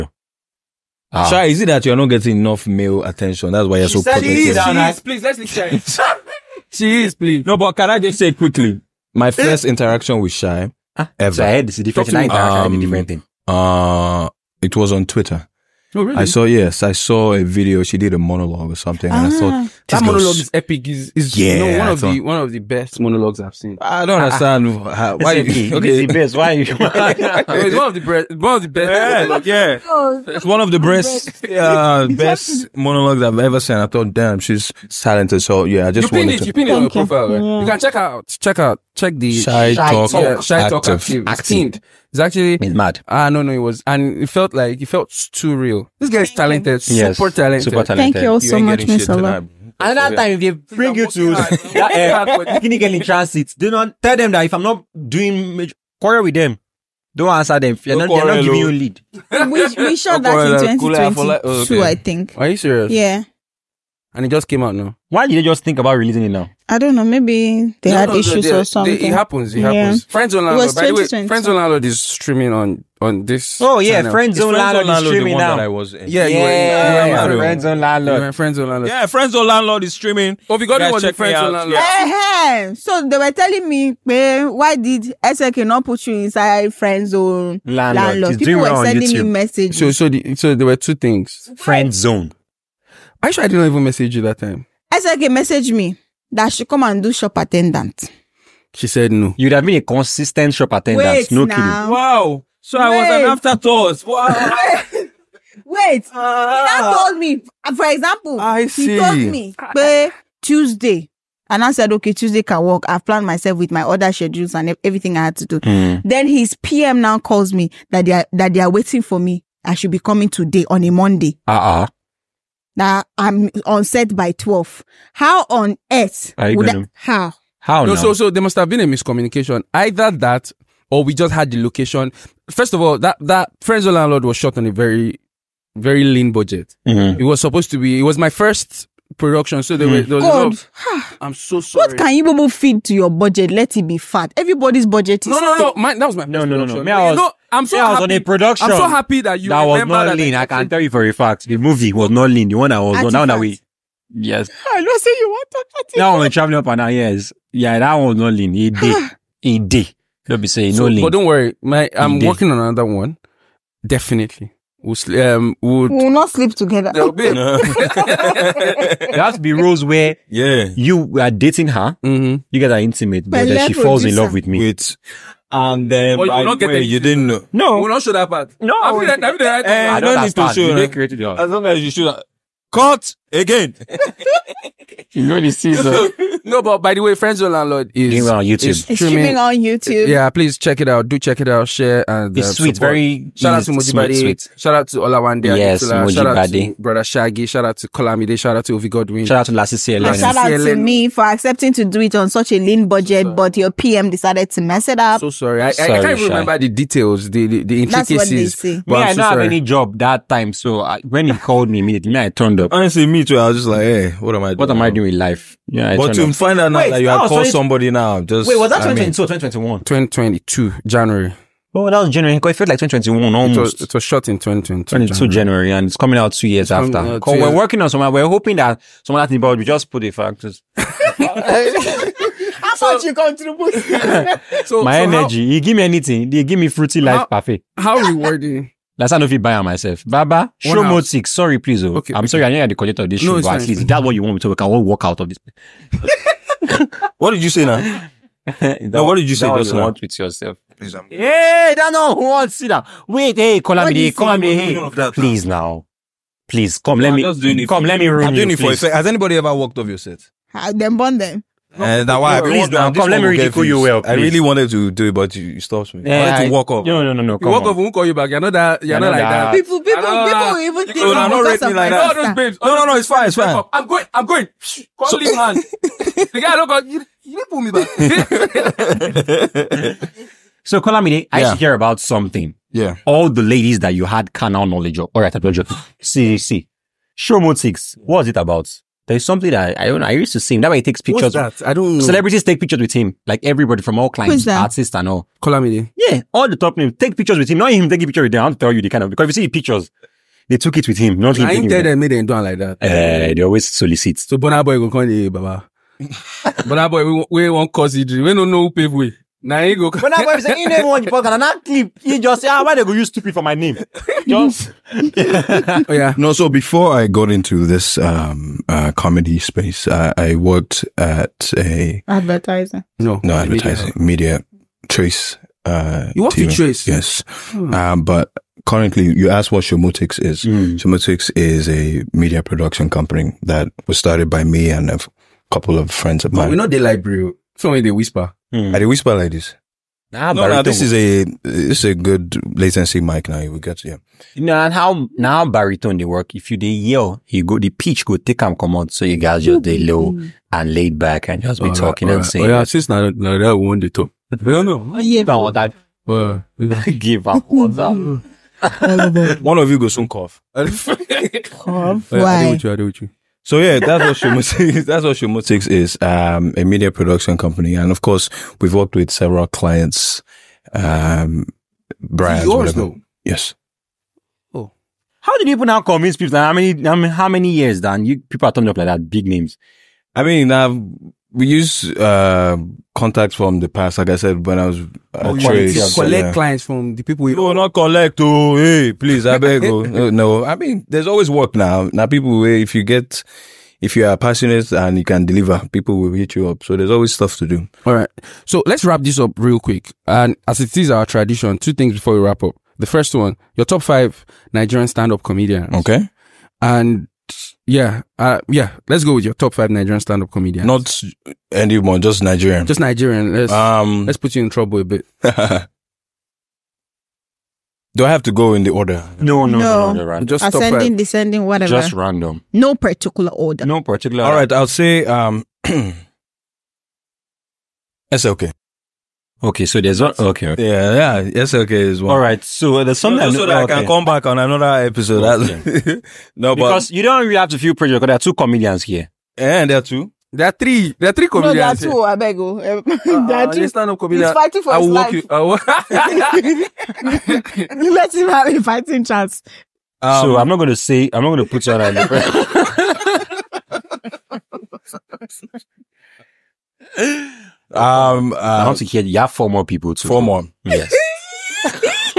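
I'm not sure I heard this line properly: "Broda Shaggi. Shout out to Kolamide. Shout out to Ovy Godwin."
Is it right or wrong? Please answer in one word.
right.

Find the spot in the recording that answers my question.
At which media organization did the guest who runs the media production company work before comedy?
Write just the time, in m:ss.
5:26.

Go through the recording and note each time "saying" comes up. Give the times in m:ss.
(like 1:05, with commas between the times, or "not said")
2:40, 5:52.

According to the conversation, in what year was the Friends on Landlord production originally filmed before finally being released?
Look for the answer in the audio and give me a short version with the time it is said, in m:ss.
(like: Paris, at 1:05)
2022, at 0:59.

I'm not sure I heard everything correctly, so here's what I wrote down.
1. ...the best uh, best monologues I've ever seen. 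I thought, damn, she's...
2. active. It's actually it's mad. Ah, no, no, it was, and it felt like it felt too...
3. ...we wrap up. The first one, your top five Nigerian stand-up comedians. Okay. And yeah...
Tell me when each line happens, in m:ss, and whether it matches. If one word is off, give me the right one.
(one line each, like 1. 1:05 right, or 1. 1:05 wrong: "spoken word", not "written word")
1. 0:30 right
2. 0:41 right
3. 6:42 right.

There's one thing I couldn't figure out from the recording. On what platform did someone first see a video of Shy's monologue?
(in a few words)
Twitter.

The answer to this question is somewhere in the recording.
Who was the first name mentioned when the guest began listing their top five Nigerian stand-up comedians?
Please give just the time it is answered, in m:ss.
7:08.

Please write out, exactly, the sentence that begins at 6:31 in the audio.
Now, people, eh, if you get, if you are passionate and you can deliver, people will hit you up.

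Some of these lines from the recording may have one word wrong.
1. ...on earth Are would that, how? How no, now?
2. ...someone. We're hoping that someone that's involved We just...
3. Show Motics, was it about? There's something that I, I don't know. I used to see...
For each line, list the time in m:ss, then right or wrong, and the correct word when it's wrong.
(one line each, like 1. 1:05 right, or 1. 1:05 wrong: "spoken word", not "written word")
1. 2:05 right
2. 3:47 right
3. 4:47 right.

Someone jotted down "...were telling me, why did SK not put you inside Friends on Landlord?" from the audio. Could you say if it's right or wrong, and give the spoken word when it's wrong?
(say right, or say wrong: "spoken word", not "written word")
right.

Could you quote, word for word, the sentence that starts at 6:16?
how many, I mean, how many years, Dan?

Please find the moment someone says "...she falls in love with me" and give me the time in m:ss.
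2:53.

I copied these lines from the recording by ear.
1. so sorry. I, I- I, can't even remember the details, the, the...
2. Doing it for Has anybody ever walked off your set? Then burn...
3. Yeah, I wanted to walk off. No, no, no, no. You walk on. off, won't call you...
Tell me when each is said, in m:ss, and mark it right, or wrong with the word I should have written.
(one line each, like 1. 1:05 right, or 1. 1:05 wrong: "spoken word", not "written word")
1. 3:25 right
2. 4:18 right
3. 4:26 right.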